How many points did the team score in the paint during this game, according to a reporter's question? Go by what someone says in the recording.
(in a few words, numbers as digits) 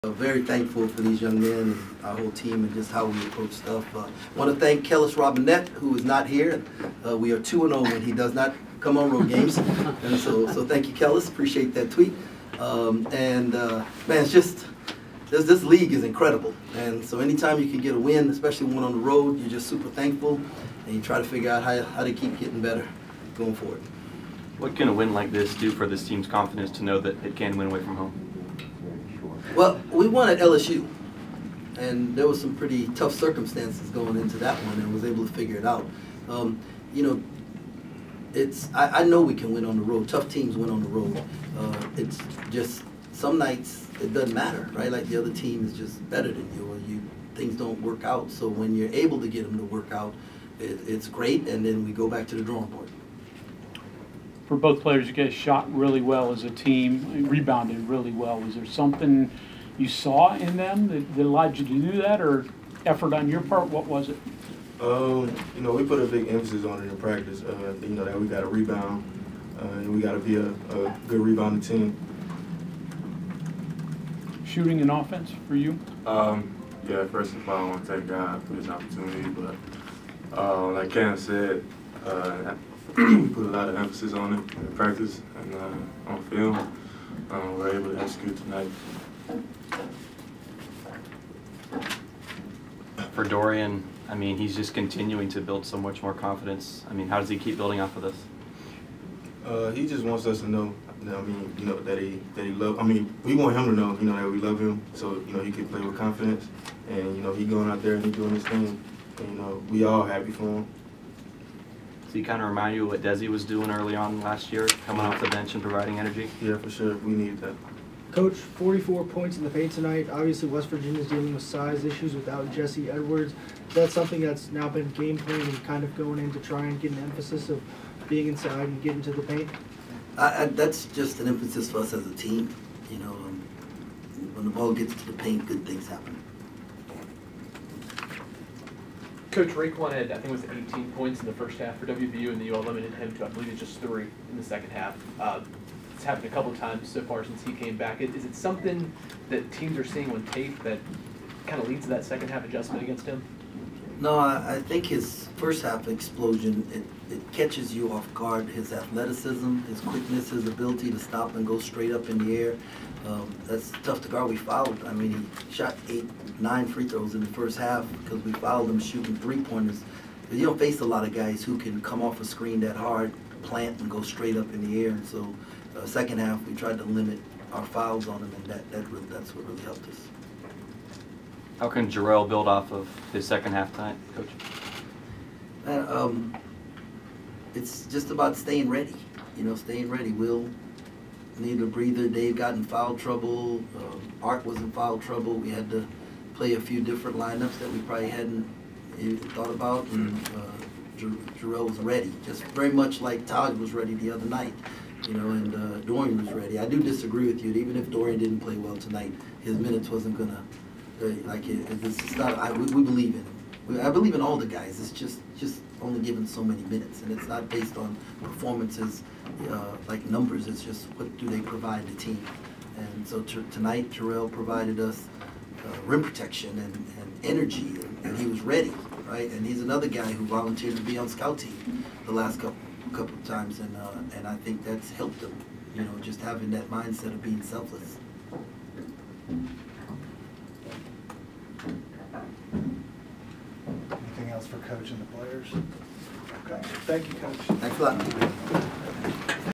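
44.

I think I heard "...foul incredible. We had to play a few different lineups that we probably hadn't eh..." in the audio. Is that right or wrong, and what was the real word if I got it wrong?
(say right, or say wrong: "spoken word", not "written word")
wrong: "trouble", not "incredible".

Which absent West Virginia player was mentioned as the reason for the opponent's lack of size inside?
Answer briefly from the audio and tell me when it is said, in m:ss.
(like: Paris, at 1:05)
Jesse Edwards, at 2:02.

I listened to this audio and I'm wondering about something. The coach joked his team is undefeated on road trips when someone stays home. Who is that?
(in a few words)
Kellis Robinett.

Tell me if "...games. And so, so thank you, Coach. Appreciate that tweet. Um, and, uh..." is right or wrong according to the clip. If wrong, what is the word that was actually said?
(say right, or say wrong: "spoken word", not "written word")
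wrong: "Kellis", not "Coach".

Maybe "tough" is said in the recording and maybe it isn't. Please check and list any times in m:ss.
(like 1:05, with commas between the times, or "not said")
0:32, 0:40, 2:43.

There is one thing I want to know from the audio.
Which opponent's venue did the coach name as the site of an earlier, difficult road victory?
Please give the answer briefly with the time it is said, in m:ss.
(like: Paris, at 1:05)
LSU, at 0:30.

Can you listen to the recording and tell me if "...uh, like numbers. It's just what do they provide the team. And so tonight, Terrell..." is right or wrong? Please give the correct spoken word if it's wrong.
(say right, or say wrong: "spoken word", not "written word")
right.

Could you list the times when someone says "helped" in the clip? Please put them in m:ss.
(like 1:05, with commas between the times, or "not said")
2:59, 3:54.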